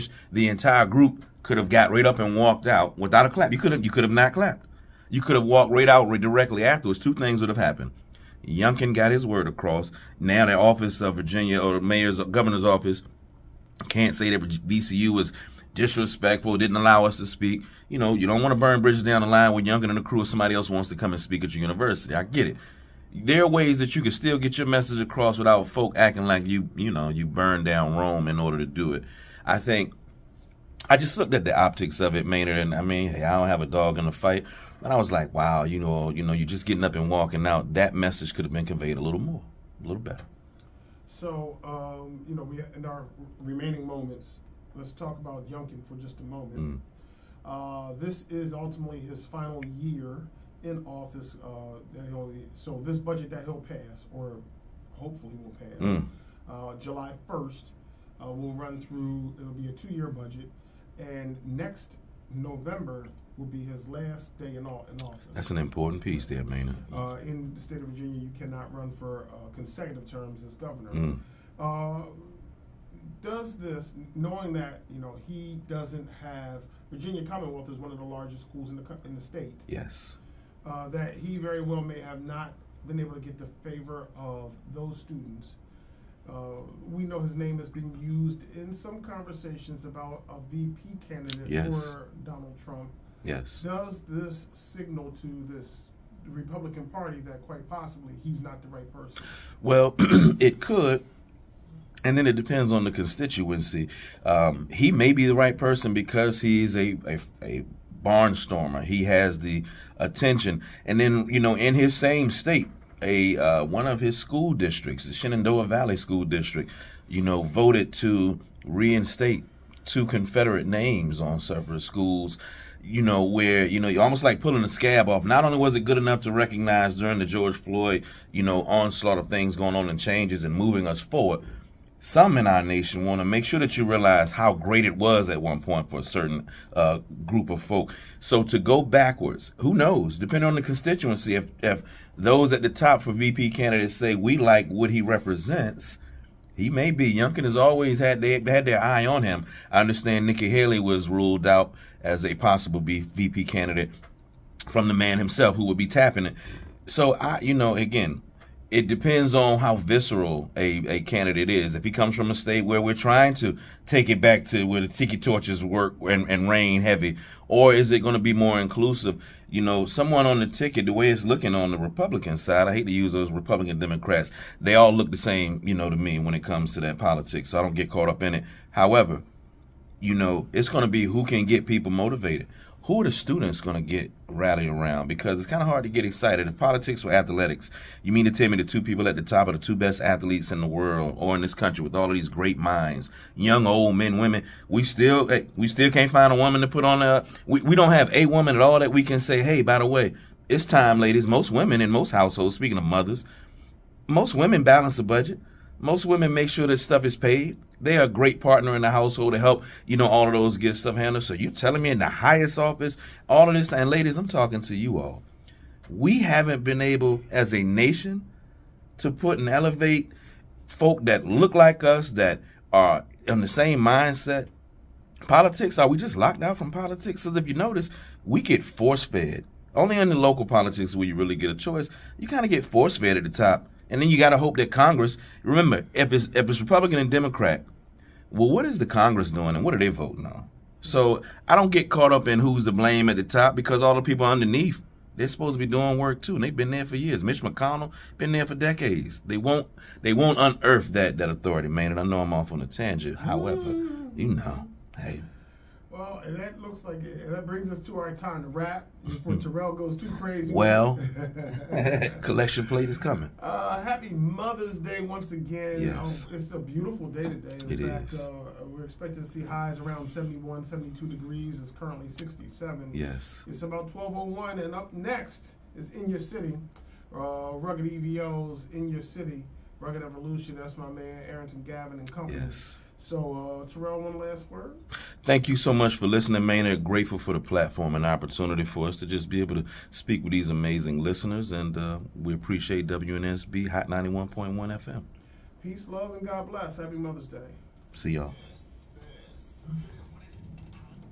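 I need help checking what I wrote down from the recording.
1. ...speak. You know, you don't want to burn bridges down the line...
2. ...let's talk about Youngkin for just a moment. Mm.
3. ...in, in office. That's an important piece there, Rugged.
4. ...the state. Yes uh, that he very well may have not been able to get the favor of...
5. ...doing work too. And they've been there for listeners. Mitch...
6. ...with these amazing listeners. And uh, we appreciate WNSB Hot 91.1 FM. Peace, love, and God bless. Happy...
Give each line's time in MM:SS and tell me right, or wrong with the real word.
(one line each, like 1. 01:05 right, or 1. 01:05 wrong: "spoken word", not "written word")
1. 00:17 right
2. 00:44 right
3. 01:04 wrong: "Maynard", not "Rugged"
4. 01:19 right
5. 04:05 wrong: "years", not "listeners"
6. 04:50 right.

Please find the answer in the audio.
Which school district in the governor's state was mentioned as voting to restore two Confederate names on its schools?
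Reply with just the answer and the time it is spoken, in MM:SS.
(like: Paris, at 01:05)
Shenandoah Valley School District, at 01:55.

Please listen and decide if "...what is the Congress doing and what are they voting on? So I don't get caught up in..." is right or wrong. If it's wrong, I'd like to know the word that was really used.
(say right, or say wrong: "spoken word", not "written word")
right.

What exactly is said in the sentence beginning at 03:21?
Most women in most households, speaking of mothers, most women balance the budget.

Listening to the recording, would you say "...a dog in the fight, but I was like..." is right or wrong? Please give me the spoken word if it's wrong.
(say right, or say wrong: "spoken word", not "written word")
right.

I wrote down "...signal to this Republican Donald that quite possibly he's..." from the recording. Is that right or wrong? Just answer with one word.
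wrong.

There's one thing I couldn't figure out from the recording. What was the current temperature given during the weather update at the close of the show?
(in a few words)
67.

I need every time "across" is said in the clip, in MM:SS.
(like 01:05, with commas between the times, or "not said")
00:09, 00:24.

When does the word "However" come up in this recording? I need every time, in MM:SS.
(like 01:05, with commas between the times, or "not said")
02:58, 04:13.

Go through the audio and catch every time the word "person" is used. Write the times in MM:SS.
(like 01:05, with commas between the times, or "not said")
01:38, 01:45.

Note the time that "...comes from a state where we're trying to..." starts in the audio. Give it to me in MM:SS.
02:41.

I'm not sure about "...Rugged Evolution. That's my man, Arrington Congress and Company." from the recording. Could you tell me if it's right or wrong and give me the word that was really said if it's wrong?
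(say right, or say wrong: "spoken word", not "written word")
wrong: "Gavin", not "Congress".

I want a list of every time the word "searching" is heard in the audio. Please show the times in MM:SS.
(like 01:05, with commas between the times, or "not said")
not said.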